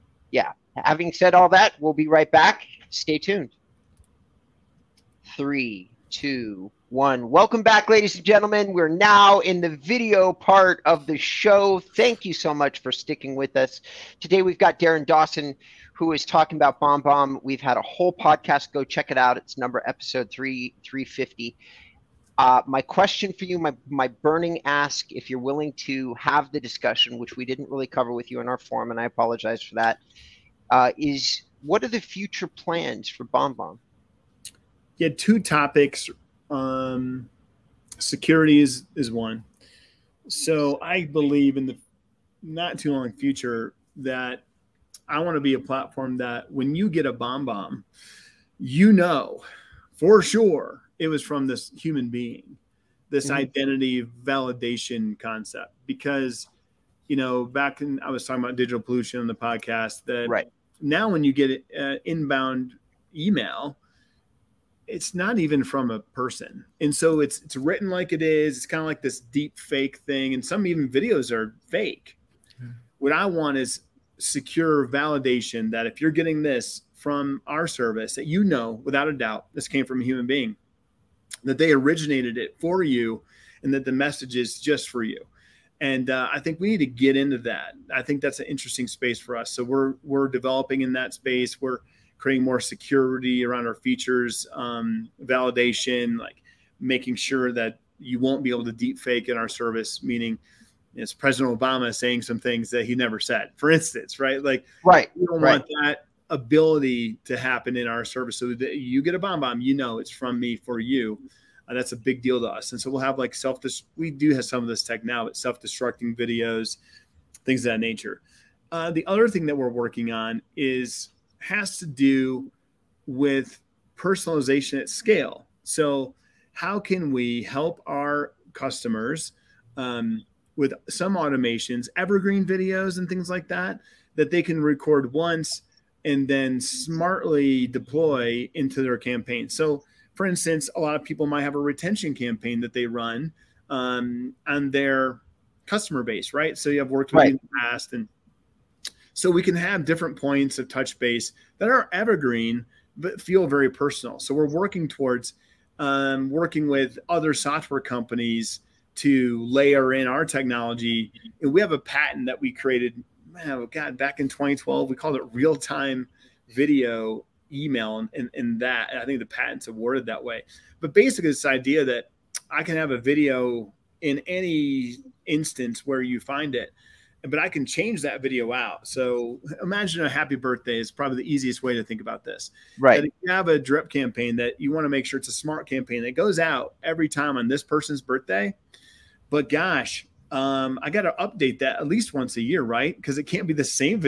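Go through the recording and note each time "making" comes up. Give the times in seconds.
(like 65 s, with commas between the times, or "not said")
96 s.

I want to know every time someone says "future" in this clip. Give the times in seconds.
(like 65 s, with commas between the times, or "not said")
31 s, 43 s.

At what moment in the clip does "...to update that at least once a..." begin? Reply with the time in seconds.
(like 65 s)
191 s.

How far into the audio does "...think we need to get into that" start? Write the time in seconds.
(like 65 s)
86 s.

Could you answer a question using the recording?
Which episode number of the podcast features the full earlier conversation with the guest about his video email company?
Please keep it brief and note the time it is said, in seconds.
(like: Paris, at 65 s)
350, at 20 s.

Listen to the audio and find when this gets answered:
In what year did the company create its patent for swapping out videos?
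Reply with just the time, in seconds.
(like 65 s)
164 s.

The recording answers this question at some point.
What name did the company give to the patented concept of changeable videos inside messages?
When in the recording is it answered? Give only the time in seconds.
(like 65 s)
165 s.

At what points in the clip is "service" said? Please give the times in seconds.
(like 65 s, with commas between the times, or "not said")
77 s, 99 s, 108 s.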